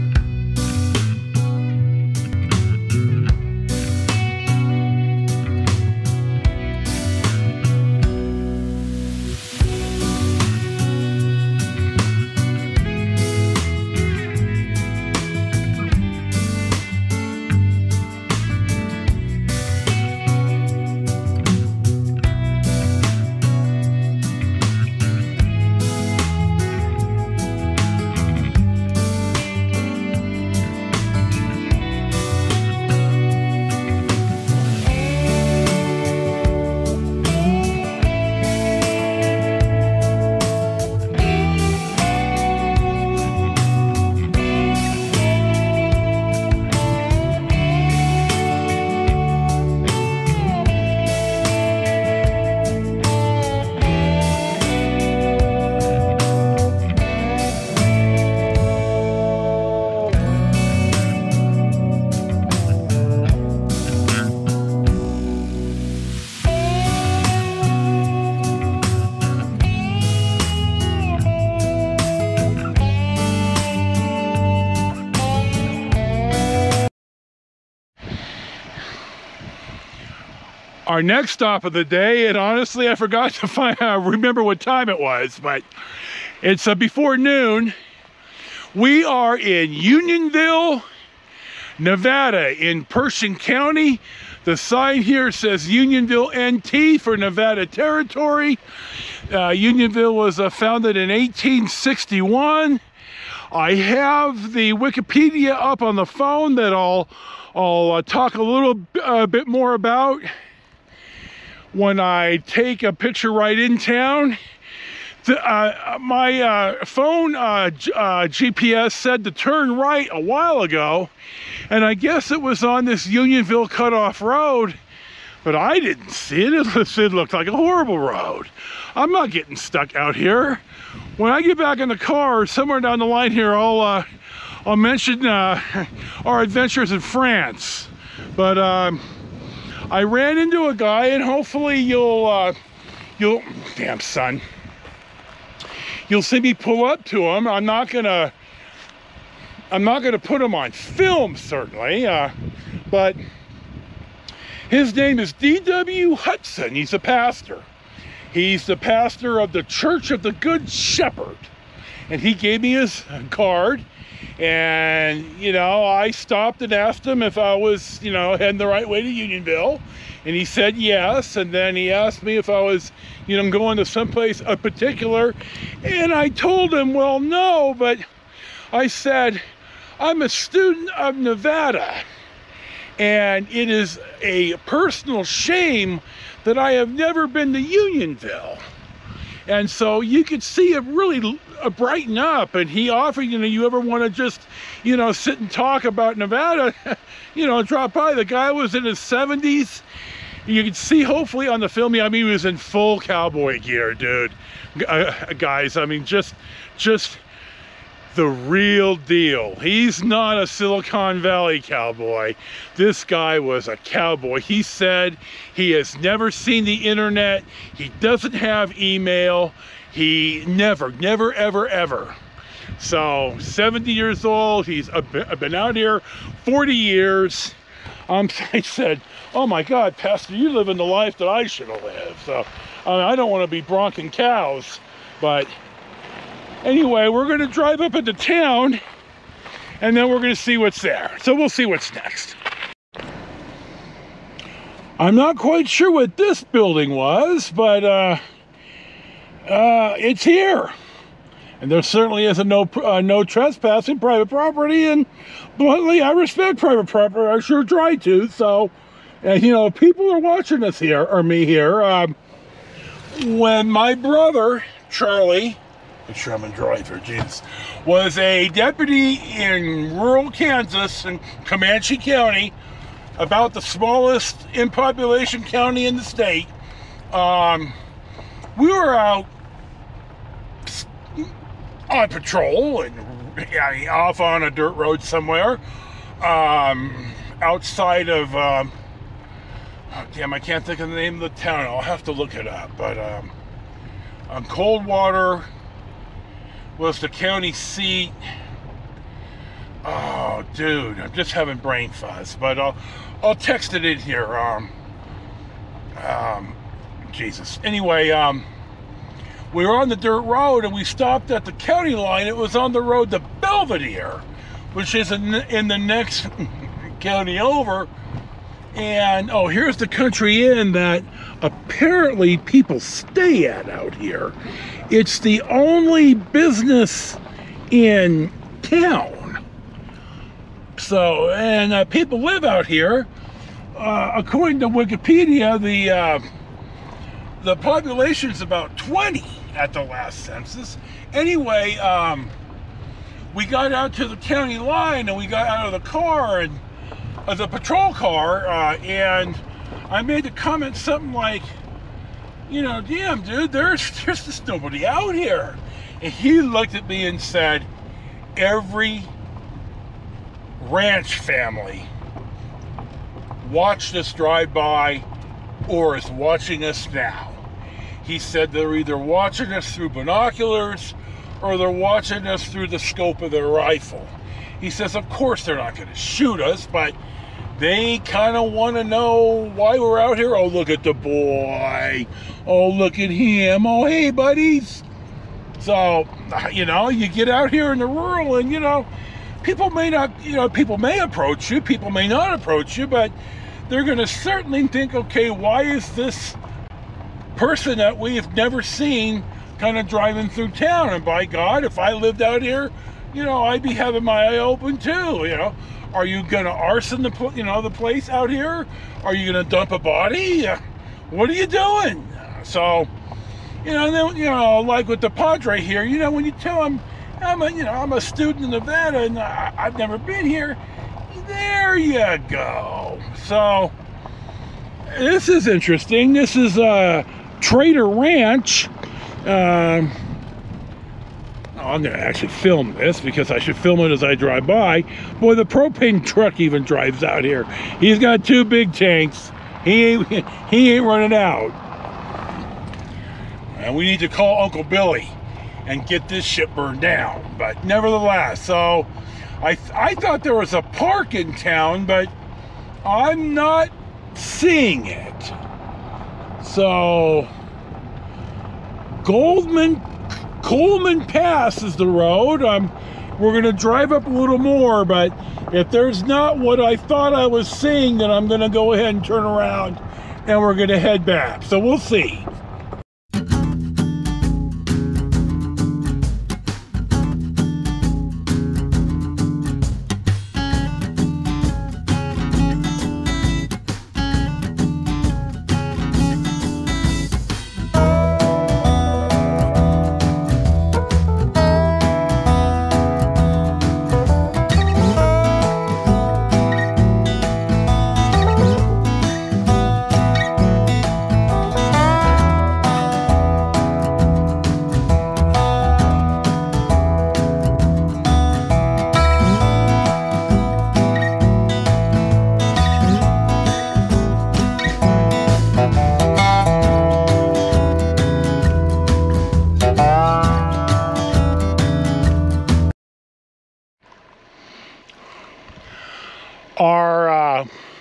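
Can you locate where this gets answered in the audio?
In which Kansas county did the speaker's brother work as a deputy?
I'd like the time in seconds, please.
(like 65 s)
271 s.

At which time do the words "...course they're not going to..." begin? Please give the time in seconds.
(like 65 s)
375 s.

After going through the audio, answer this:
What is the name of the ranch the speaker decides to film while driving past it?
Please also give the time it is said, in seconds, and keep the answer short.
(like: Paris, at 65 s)
Trader Ranch, at 427 s.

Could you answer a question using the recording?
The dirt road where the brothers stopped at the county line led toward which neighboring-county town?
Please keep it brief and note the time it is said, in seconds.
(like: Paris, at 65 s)
Belvidere, at 313 s.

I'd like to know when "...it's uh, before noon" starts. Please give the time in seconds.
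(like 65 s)
86 s.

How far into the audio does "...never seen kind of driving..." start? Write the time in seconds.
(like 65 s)
398 s.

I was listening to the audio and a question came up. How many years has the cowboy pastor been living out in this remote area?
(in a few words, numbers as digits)
40 years.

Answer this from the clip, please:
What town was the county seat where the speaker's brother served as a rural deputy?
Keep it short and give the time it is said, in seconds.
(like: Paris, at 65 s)
Coldwater, at 294 s.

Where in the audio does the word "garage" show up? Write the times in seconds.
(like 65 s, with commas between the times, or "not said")
not said.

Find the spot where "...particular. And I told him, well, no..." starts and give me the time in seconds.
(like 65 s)
174 s.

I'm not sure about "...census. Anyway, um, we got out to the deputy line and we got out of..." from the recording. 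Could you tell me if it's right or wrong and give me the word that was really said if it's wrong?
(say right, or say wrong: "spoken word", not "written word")
wrong: "county", not "deputy".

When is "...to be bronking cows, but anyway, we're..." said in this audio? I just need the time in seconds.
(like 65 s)
233 s.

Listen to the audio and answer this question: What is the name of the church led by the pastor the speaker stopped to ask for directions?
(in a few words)
Church of the Good Shepherd.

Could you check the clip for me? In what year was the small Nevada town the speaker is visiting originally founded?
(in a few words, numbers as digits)
1861.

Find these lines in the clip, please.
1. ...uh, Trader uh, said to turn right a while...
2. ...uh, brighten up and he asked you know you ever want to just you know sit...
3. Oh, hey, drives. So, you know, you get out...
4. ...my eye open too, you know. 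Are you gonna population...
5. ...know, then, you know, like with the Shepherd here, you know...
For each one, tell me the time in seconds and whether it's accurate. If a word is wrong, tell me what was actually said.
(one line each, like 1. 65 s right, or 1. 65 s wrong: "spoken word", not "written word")
1. 117 s wrong: "GPS", not "Trader"
2. 191 s wrong: "offered", not "asked"
3. 383 s wrong: "buddies", not "drives"
4. 404 s wrong: "arson", not "population"
5. 413 s wrong: "Padre", not "Shepherd".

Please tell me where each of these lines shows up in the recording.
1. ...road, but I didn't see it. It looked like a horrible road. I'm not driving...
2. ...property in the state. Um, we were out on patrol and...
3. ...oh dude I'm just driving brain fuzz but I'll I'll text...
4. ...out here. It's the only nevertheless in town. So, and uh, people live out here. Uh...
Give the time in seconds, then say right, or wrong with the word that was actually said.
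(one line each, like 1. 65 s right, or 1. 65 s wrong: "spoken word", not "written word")
1. 124 s wrong: "getting", not "driving"
2. 275 s wrong: "county", not "property"
3. 299 s wrong: "having", not "driving"
4. 323 s wrong: "business", not "nevertheless".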